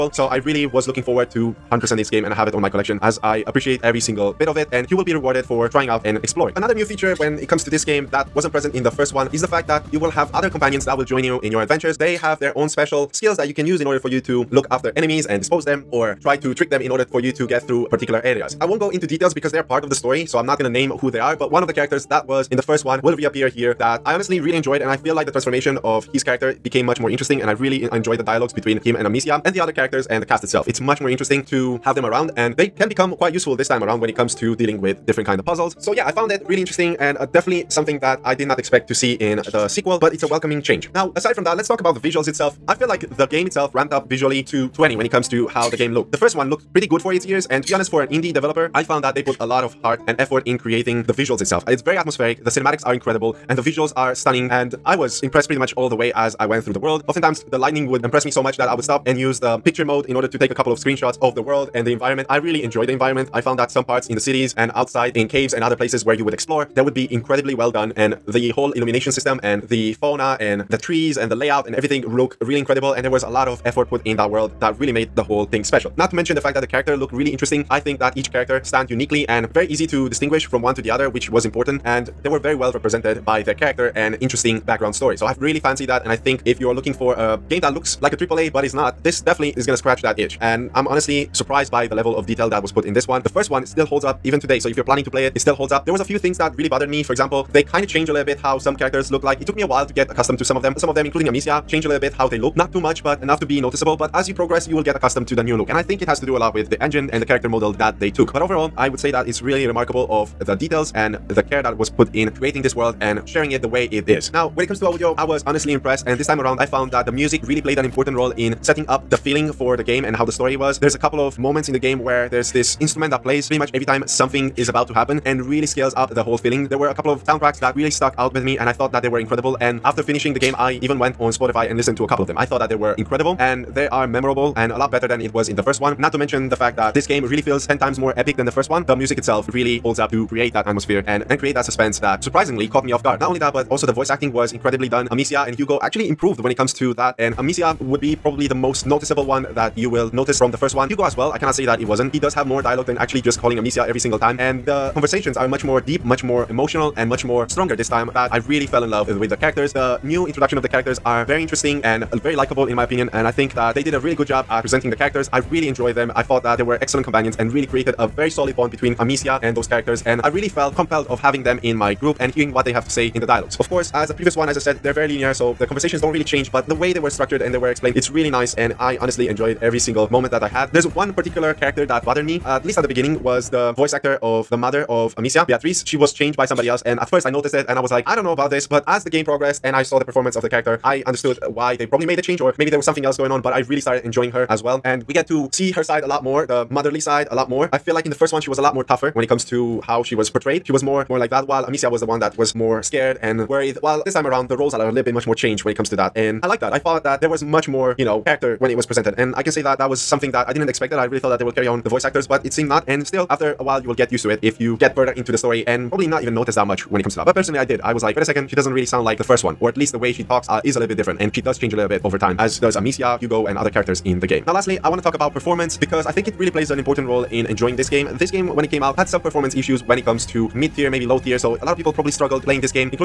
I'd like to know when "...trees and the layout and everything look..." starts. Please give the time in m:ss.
1:10.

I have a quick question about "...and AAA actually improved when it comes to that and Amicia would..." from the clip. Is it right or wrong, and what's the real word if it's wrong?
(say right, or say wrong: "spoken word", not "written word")
wrong: "Hugo", not "AAA".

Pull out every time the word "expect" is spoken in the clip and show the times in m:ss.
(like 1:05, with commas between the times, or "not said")
0:38, 3:30.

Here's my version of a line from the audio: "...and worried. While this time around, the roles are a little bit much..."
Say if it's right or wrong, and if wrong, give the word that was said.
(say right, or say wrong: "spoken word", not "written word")
right.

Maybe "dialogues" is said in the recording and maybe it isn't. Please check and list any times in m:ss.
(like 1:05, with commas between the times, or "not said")
0:28, 2:32, 2:53.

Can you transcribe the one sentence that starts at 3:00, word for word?
There's one particular character that bothered me, at least at the beginning, was the voice actor of the mother of Amicia, Beatrice.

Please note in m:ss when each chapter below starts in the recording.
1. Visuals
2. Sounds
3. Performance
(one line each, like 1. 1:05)
1. 0:41
2. 1:54
3. 3:44.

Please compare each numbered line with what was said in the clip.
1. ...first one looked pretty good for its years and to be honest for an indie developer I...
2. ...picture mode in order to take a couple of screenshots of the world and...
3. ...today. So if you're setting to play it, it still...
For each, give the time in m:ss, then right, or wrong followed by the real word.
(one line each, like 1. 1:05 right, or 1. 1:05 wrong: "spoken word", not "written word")
1. 0:46 right
2. 0:59 right
3. 1:34 wrong: "planning", not "setting".